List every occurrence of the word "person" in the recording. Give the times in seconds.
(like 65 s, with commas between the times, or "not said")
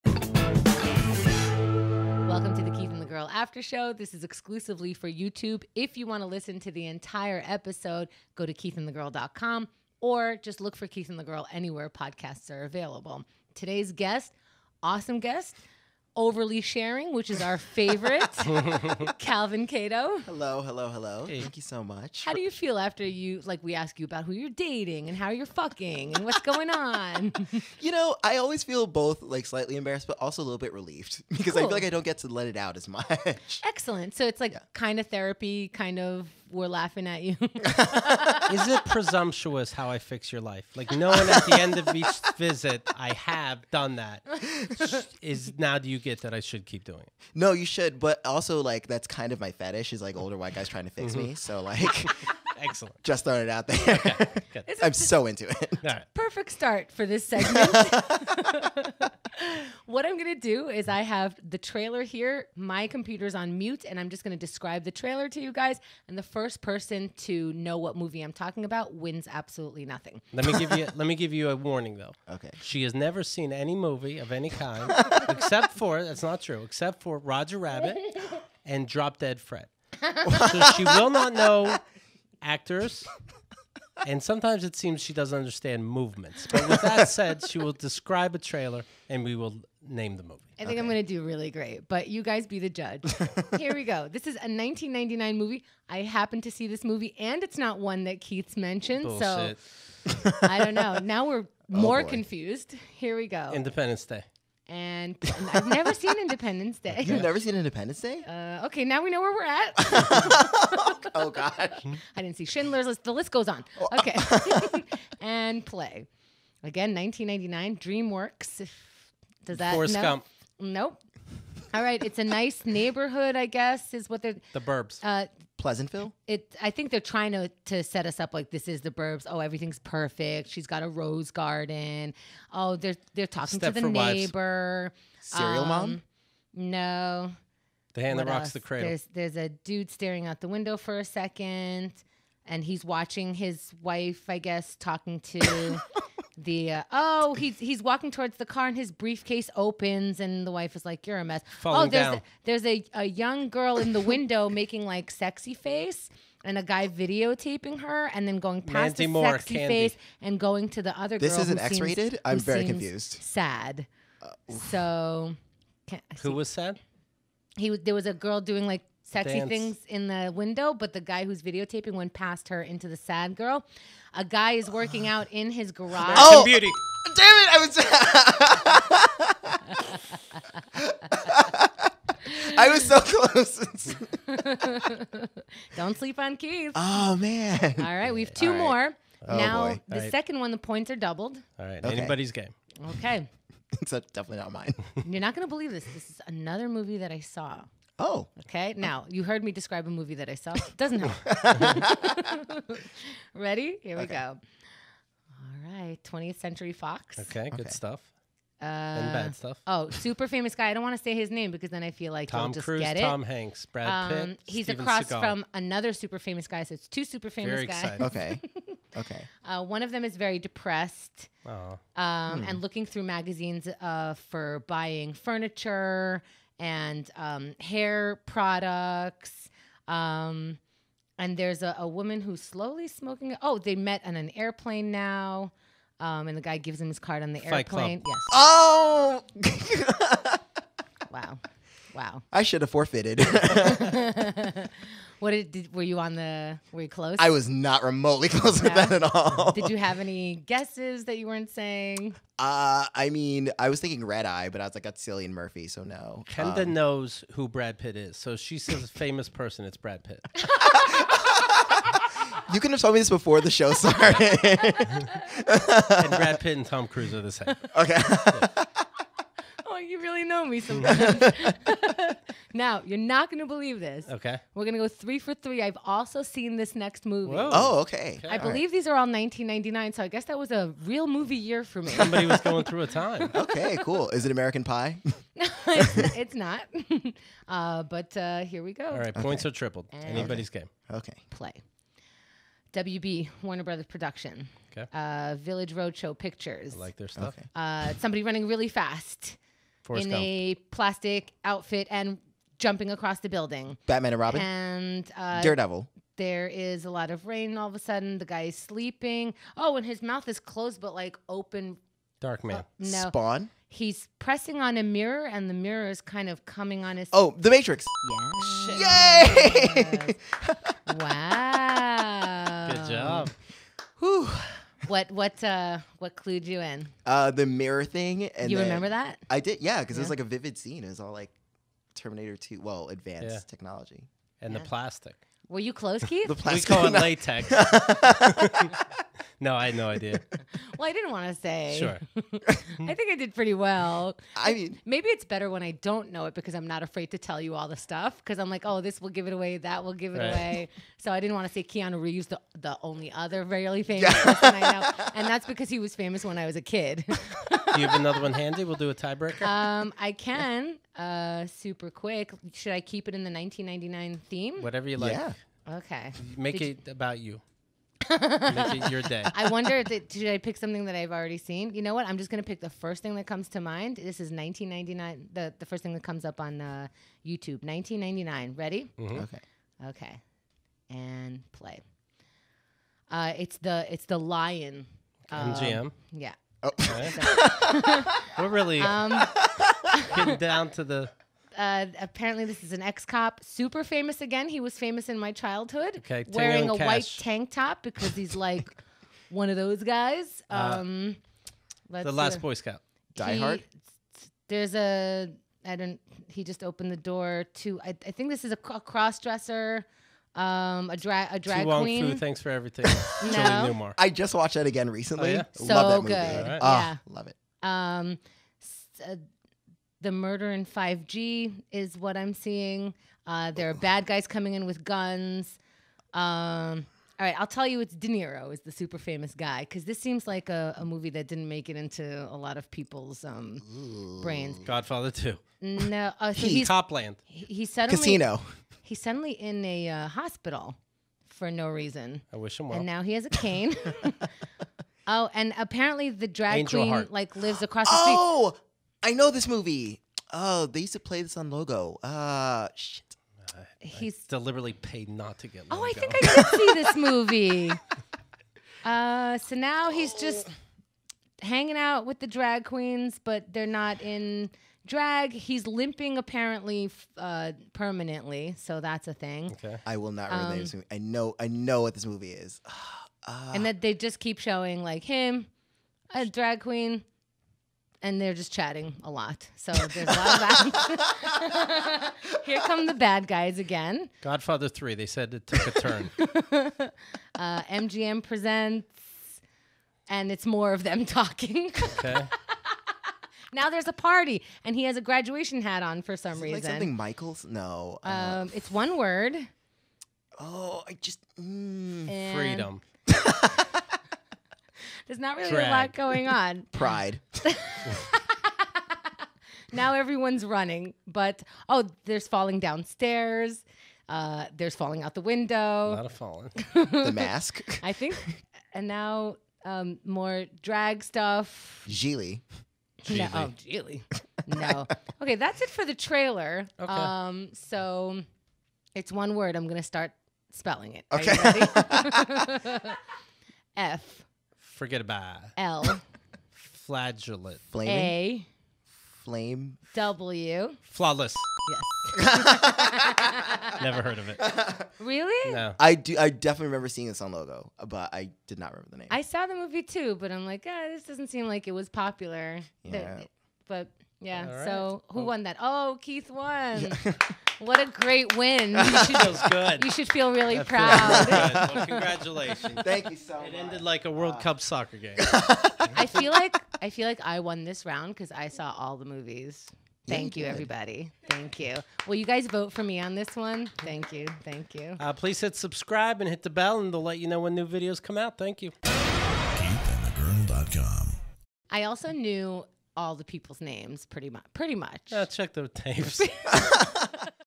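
66 s, 259 s, 354 s.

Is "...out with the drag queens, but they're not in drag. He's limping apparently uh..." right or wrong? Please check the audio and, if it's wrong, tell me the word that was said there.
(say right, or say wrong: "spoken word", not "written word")
right.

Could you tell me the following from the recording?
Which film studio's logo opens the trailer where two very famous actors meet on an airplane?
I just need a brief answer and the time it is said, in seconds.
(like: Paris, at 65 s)
20th Century Fox, at 206 s.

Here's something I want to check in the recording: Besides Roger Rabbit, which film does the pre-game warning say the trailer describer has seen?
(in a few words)
Drop Dead Fred.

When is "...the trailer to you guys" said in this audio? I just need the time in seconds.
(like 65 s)
64 s.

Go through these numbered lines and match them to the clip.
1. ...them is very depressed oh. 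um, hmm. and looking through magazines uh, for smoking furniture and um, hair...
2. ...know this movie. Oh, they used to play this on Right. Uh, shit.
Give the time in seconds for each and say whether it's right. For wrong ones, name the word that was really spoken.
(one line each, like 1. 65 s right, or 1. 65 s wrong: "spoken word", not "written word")
1. 219 s wrong: "buying", not "smoking"
2. 449 s wrong: "Logo", not "Right".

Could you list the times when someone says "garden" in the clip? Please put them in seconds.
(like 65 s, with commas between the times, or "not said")
131 s.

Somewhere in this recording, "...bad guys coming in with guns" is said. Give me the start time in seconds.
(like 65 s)
423 s.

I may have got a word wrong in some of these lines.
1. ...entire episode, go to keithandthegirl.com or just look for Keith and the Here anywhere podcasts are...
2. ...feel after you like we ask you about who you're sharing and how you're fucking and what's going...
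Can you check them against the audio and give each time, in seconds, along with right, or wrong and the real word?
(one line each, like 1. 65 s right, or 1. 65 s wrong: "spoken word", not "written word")
1. 6 s wrong: "Girl", not "Here"
2. 22 s wrong: "dating", not "sharing".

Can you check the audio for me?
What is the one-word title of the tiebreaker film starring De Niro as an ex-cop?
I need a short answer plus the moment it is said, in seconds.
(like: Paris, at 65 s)
Flawless, at 540 s.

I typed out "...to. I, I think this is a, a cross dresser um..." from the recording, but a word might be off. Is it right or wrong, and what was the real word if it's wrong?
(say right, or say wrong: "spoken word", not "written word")
right.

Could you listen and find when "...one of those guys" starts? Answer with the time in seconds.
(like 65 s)
399 s.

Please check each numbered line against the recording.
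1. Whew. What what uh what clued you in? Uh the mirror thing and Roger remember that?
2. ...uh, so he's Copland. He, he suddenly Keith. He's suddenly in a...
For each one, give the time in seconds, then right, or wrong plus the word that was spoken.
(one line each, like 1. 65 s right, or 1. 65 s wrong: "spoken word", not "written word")
1. 323 s wrong: "You", not "Roger"
2. 436 s wrong: "Casino", not "Keith".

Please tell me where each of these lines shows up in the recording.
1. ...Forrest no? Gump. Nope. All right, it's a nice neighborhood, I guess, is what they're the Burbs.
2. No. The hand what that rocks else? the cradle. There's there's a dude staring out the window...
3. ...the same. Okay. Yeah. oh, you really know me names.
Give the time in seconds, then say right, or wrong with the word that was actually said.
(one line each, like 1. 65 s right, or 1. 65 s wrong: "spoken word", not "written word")
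1. 119 s right
2. 136 s right
3. 267 s wrong: "sometimes", not "names".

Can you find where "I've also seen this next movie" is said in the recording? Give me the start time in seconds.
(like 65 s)
275 s.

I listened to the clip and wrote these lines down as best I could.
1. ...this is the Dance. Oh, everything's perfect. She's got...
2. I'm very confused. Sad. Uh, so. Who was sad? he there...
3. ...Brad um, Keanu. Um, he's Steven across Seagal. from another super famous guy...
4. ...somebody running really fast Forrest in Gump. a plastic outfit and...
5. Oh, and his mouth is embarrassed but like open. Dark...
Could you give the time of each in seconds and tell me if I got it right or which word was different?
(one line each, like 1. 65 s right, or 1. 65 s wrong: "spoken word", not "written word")
1. 128 s wrong: "Burbs", not "Dance"
2. 162 s right
3. 213 s wrong: "Pitt", not "Keanu"
4. 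297 s right
5. 309 s wrong: "closed", not "embarrassed".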